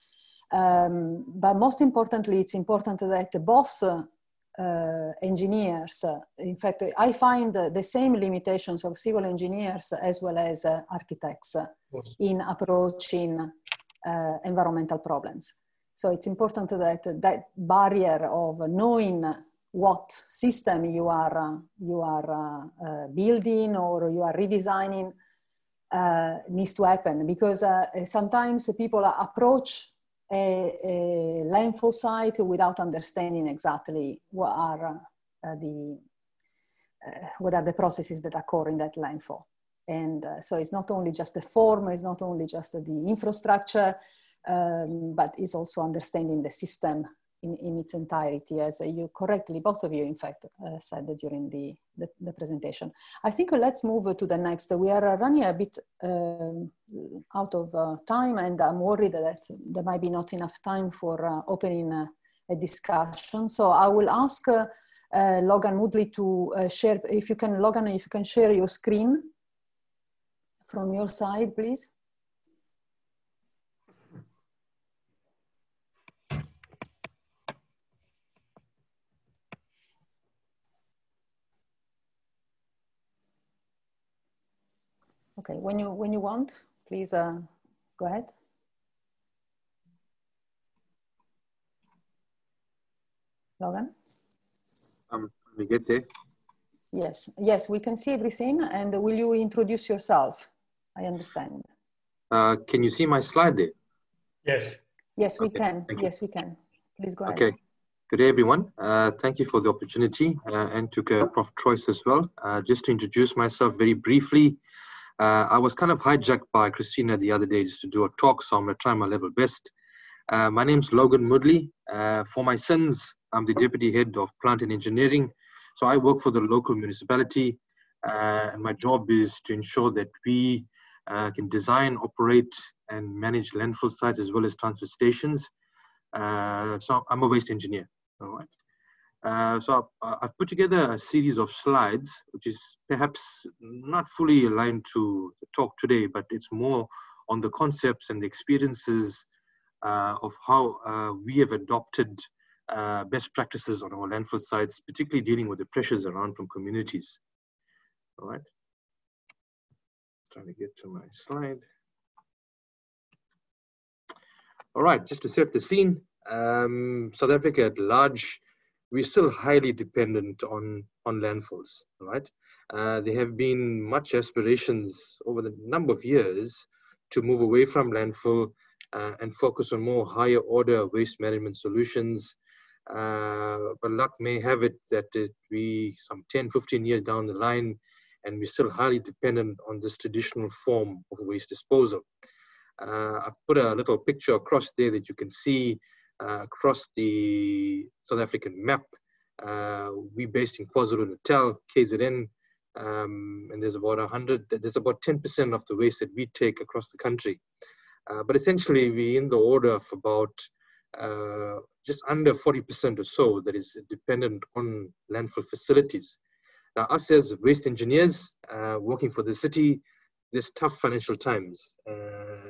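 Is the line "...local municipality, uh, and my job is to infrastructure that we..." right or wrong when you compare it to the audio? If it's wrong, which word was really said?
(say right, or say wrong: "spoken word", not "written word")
wrong: "ensure", not "infrastructure".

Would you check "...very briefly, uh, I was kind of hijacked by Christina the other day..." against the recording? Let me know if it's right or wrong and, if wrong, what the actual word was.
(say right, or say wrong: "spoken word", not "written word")
right.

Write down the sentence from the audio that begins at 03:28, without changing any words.
Uh, but essentially, we're in the order of about uh, just under 40% or so that is dependent on landfill facilities.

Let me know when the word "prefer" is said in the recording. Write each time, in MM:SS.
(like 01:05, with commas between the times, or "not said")
not said.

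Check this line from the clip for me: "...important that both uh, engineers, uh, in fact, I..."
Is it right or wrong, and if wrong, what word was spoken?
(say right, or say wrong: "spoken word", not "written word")
right.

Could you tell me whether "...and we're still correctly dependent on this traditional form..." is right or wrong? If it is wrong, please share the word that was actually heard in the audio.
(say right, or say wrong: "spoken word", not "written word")
wrong: "highly", not "correctly".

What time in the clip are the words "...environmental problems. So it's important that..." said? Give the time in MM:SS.
00:14.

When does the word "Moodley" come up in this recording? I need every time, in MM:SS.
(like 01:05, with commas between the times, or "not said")
01:05, 02:01.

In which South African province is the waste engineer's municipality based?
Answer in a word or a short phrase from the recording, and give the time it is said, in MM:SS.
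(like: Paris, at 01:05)
KwaZulu-Natal, at 03:20.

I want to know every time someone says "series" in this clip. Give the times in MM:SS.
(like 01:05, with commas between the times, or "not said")
02:20.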